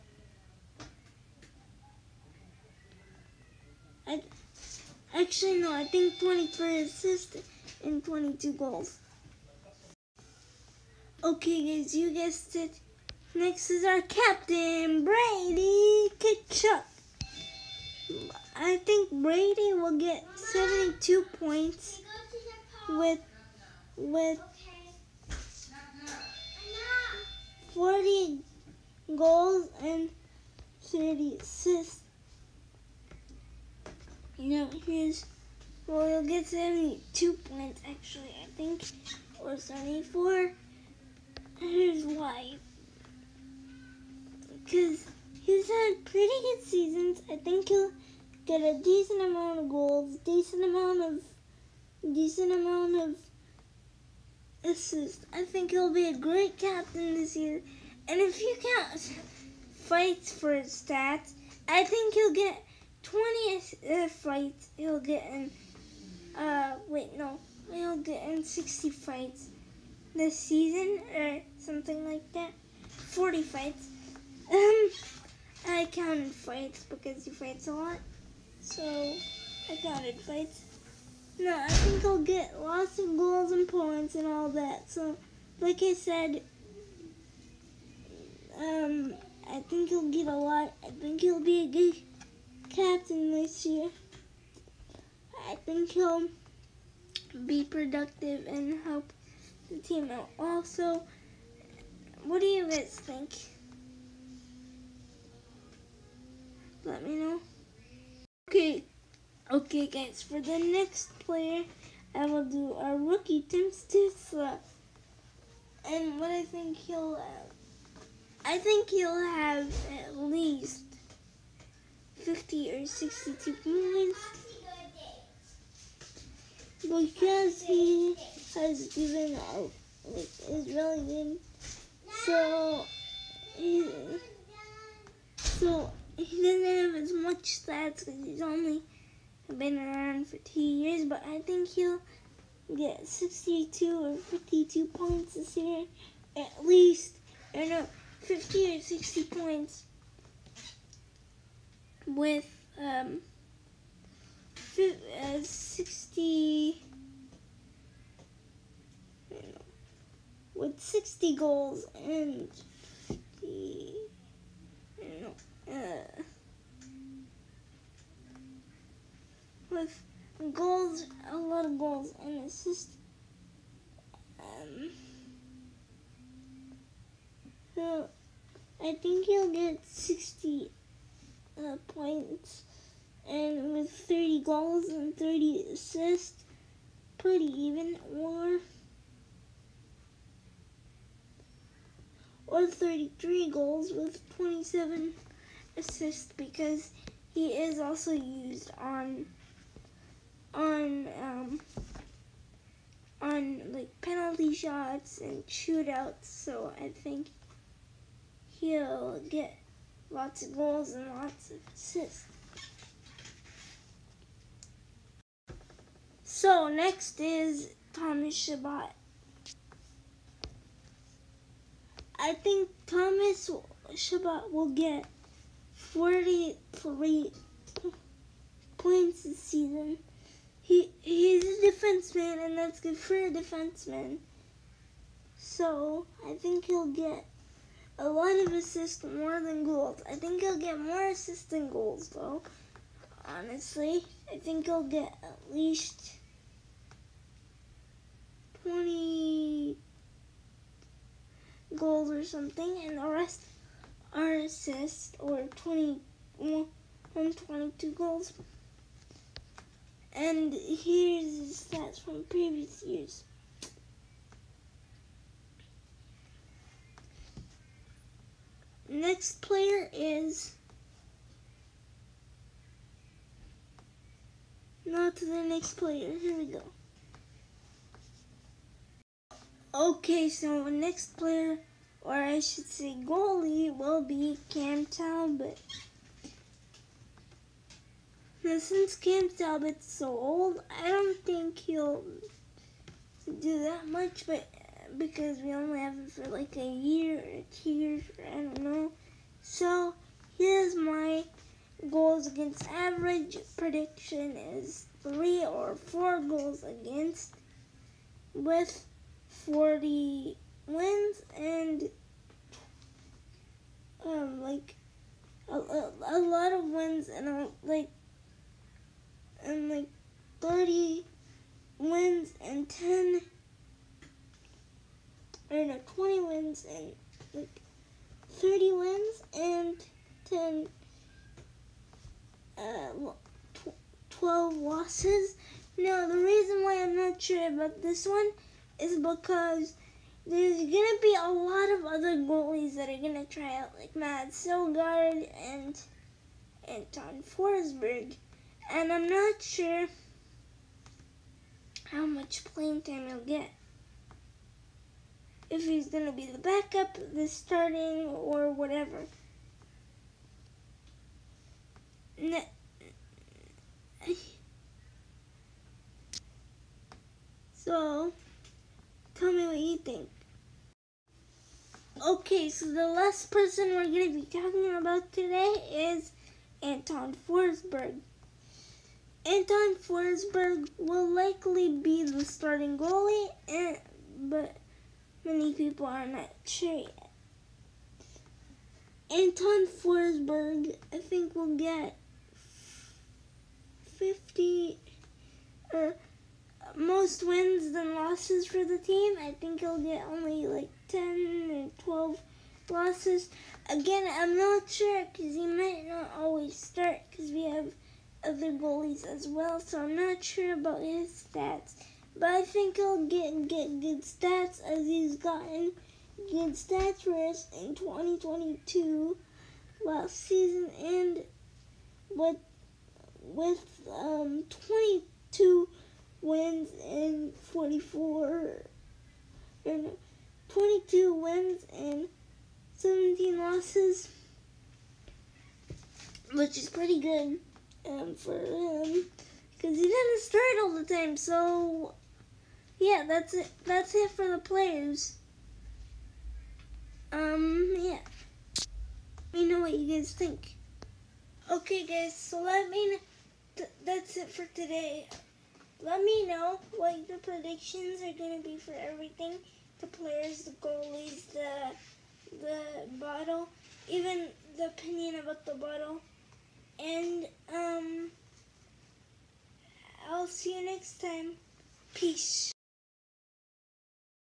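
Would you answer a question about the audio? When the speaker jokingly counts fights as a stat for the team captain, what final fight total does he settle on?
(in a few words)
40.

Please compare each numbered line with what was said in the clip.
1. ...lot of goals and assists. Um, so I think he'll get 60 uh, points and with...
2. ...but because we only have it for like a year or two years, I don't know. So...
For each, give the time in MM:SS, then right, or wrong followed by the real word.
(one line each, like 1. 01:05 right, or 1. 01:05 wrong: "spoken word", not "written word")
1. 02:51 right
2. 04:54 right.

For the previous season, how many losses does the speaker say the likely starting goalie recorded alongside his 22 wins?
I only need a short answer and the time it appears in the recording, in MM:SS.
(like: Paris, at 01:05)
17, at 07:12.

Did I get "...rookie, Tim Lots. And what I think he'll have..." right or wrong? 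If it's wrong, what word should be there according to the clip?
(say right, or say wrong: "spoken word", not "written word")
wrong: "Stützle", not "Lots".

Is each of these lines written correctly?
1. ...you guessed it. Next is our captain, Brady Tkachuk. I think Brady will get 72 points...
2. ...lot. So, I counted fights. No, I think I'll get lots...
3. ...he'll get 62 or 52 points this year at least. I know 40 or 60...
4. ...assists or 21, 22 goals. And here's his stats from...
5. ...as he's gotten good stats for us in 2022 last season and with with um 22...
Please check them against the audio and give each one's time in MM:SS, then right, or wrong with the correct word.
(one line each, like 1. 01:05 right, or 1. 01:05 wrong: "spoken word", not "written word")
1. 00:11 right
2. 01:17 right
3. 02:21 wrong: "50", not "40"
4. 04:14 right
5. 06:54 right.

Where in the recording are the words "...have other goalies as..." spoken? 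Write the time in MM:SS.
06:47.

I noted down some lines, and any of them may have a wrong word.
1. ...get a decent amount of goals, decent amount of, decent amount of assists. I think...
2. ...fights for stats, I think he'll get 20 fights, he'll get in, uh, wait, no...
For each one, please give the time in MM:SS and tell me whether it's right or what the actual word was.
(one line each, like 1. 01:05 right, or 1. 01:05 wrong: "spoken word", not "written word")
1. 00:48 right
2. 00:59 right.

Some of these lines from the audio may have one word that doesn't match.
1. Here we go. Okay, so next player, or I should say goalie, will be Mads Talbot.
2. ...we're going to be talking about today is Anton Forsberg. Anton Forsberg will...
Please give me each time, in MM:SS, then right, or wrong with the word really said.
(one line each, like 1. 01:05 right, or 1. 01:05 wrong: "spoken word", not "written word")
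1. 04:36 wrong: "Cam", not "Mads"
2. 06:13 right.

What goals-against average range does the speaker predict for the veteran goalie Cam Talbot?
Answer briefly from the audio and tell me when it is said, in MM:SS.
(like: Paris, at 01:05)
3 or 4, at 05:05.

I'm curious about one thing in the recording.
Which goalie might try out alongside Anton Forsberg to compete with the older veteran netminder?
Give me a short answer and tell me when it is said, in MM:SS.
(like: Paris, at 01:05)
Mads Søgaard, at 05:43.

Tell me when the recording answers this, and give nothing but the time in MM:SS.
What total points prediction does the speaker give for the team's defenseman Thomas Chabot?
03:45.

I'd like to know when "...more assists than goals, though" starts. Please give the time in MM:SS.
04:00.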